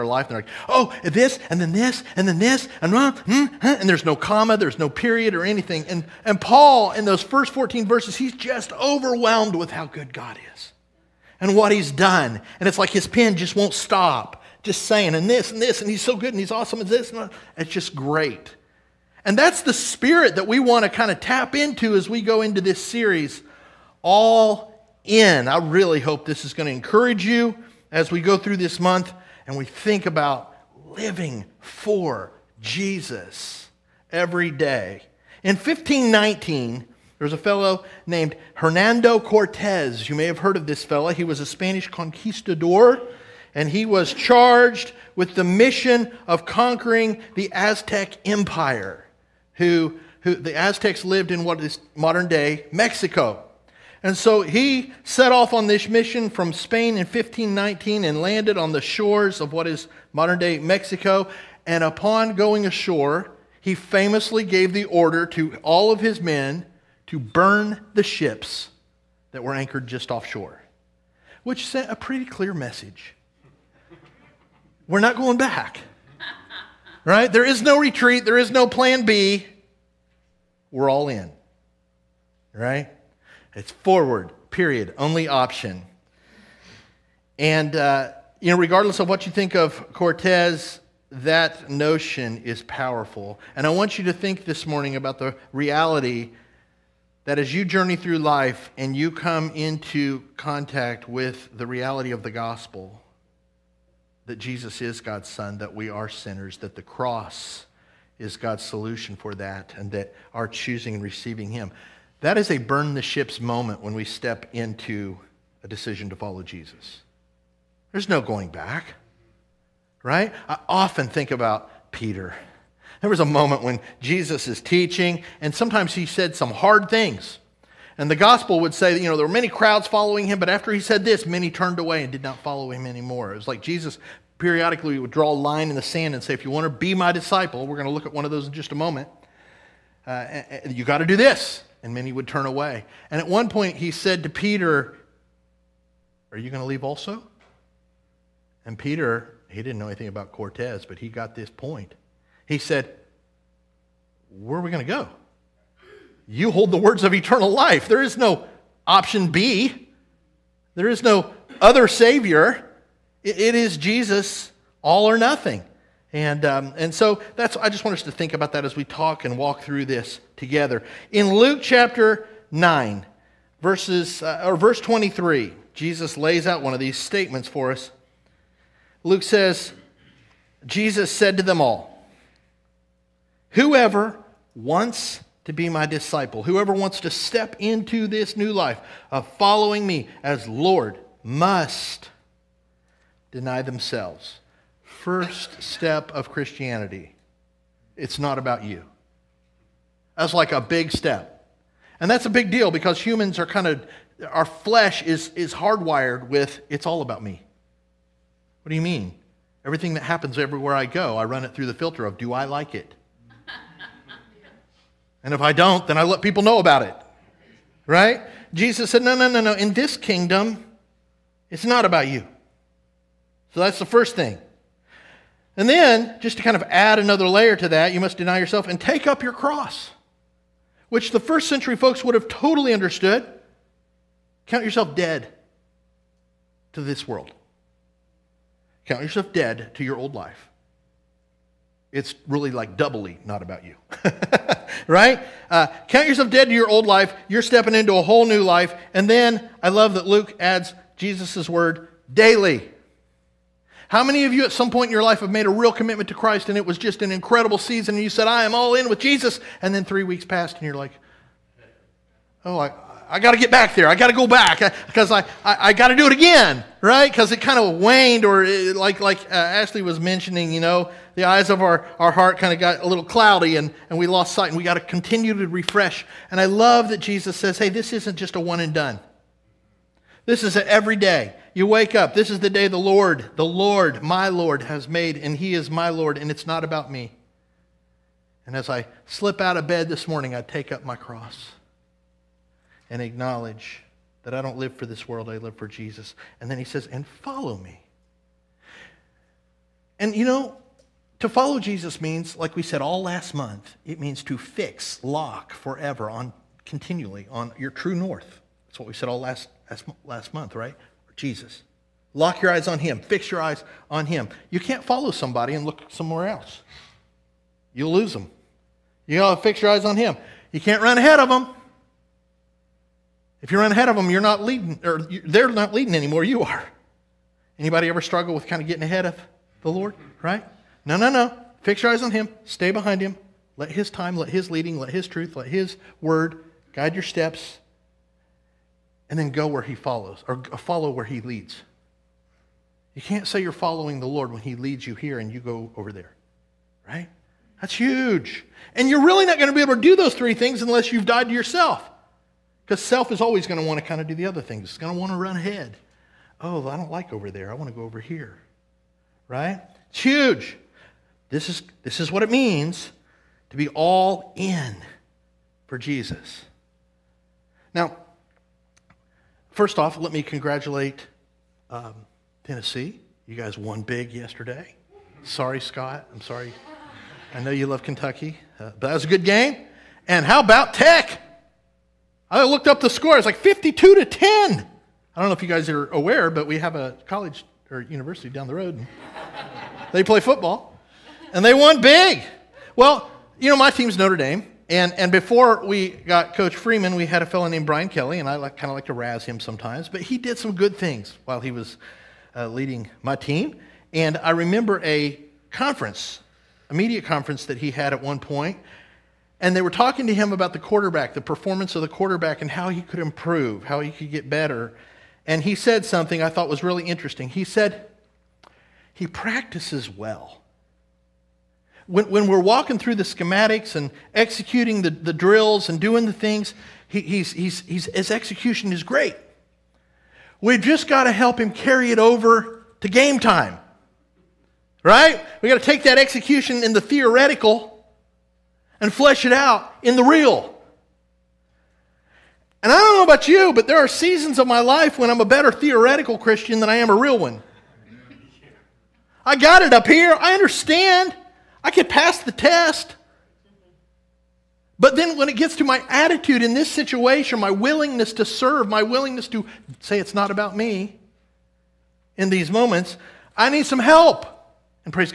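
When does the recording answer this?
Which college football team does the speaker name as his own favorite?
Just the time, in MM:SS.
06:33.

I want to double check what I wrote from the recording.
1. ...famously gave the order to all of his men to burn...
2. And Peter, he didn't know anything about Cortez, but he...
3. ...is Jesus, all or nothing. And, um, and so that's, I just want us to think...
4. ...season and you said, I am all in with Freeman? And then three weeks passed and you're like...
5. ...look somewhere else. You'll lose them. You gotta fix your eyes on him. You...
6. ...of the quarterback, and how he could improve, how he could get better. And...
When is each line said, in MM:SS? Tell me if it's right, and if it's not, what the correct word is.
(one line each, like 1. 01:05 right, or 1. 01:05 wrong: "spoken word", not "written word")
1. 01:03 right
2. 02:28 right
3. 02:43 right
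4. 04:17 wrong: "Jesus", not "Freeman"
5. 05:15 right
6. 06:51 right.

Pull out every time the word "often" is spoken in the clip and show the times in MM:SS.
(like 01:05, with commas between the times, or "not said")
02:00.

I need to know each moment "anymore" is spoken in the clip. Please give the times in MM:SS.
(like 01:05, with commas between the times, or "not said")
02:12, 05:25.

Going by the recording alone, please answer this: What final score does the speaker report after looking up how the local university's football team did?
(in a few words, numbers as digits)
52 to 10.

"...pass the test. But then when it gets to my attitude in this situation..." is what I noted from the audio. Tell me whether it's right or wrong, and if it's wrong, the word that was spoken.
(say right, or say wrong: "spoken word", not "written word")
right.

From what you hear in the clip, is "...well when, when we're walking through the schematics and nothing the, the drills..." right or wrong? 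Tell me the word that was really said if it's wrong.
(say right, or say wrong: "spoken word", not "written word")
wrong: "executing", not "nothing".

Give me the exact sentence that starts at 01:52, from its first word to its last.
That is a burn the ships moment when we step into a decision to follow Jesus.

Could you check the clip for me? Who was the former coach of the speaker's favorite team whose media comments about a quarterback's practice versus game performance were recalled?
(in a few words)
Brian Kelly.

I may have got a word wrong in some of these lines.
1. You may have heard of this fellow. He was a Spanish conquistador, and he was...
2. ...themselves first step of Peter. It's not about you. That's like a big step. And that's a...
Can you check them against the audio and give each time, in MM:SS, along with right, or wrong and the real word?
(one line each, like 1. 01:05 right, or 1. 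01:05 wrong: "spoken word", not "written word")
1. 00:40 right
2. 03:13 wrong: "Christianity", not "Peter".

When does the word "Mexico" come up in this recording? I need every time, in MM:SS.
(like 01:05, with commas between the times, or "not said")
00:52, 01:00.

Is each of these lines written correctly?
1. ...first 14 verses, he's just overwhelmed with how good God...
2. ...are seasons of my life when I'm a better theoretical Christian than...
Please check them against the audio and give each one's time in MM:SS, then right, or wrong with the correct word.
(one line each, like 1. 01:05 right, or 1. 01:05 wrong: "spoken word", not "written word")
1. 00:07 right
2. 07:23 right.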